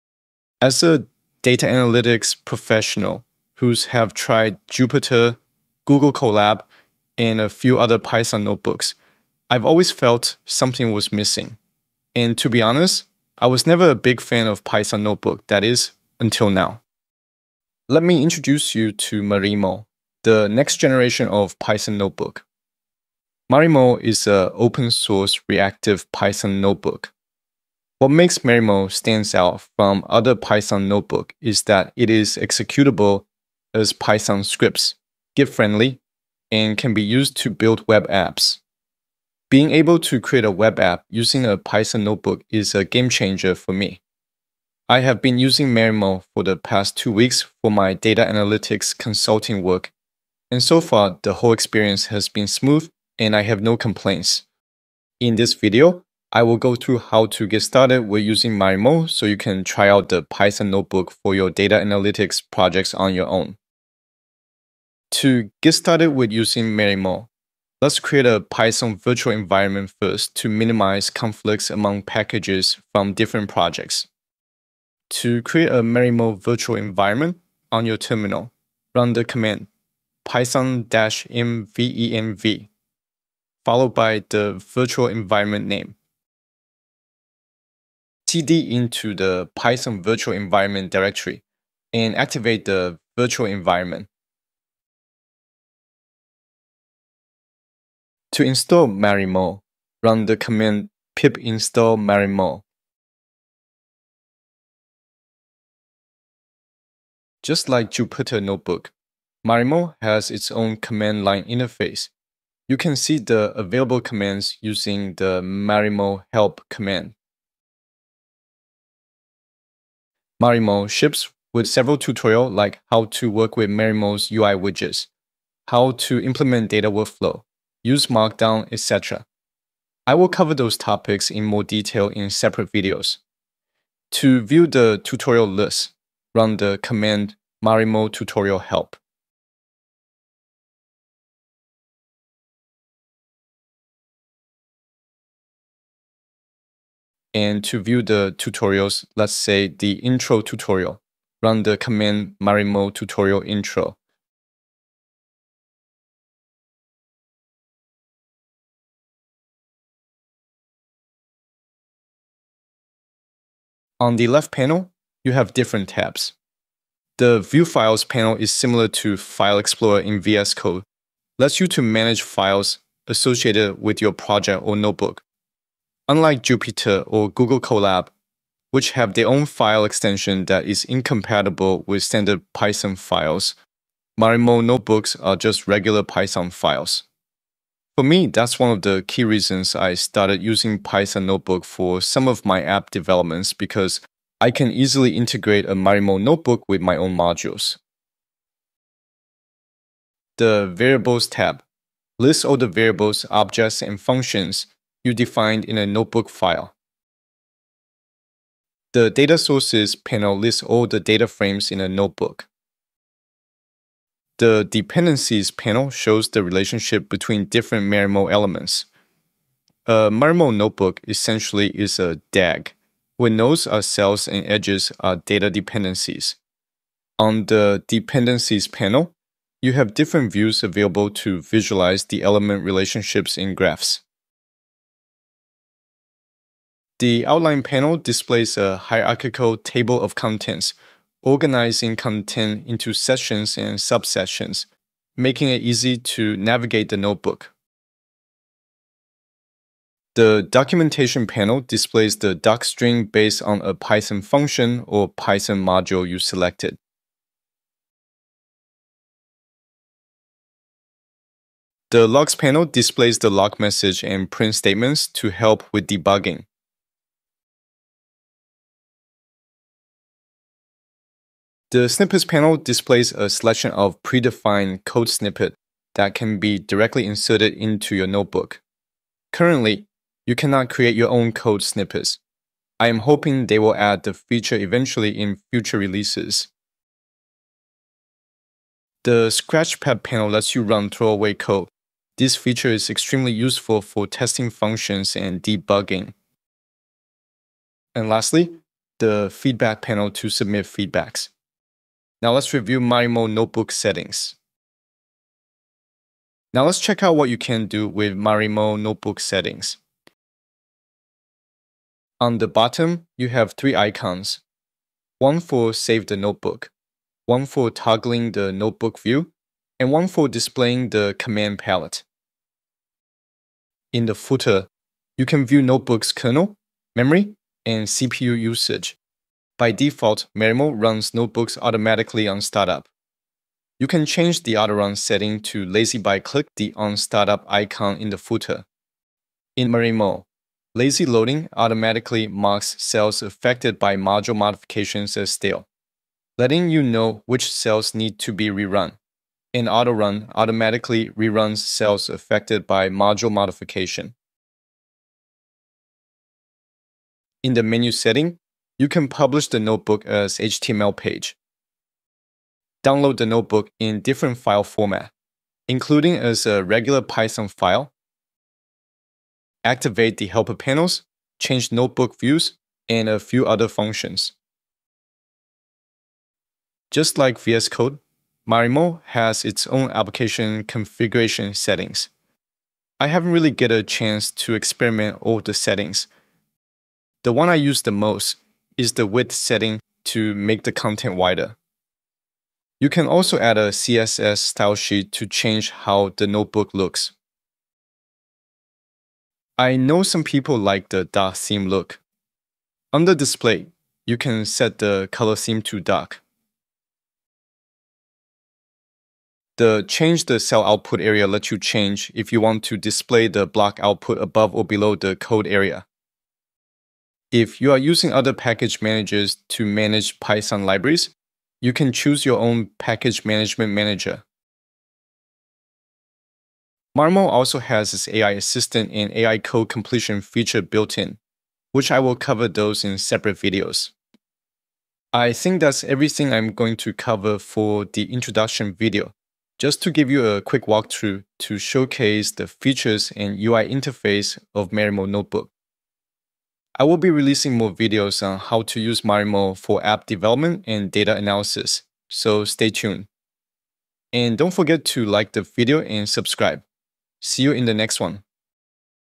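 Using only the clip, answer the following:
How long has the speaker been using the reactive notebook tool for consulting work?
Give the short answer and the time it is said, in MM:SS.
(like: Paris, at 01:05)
two weeks, at 00:46.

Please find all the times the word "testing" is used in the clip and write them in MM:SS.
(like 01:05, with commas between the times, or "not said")
04:54.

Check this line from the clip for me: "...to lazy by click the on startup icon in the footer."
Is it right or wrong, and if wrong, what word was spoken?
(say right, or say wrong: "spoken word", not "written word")
right.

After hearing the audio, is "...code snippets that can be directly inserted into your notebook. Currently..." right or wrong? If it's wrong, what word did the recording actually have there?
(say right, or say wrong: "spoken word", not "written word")
right.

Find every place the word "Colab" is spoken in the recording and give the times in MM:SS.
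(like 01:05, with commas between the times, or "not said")
00:06, 02:57.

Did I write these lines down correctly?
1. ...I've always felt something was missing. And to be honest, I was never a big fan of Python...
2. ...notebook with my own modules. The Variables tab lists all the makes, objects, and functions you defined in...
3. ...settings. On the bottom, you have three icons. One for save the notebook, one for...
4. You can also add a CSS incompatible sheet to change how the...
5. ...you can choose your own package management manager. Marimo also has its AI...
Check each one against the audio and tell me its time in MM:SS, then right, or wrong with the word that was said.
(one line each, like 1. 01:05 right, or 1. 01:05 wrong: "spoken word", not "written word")
1. 00:09 right
2. 03:16 wrong: "variables", not "makes"
3. 05:09 right
4. 06:32 wrong: "style", not "incompatible"
5. 07:01 right.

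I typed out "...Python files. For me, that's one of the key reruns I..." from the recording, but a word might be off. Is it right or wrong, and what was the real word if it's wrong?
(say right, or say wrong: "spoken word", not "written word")
wrong: "reasons", not "reruns".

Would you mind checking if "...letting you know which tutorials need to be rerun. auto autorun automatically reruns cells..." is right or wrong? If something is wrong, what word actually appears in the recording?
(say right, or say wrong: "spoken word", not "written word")
wrong: "cells", not "tutorials".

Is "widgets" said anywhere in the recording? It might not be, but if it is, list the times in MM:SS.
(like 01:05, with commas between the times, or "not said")
02:04.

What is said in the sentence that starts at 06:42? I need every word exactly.
Under display, you can set the color theme to dark.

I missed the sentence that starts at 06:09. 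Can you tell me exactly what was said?
Activate the helper panels, change notebook views, and a few other functions.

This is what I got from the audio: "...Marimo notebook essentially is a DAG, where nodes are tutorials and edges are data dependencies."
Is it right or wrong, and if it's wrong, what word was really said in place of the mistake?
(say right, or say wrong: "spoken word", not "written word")
wrong: "cells", not "tutorials".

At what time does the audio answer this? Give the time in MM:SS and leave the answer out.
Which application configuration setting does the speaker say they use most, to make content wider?
06:29.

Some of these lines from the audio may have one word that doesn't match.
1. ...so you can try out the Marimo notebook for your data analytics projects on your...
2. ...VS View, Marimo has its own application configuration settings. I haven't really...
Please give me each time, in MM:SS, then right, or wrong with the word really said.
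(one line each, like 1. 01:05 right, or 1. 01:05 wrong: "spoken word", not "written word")
1. 00:59 wrong: "Python", not "Marimo"
2. 06:17 wrong: "Code", not "View".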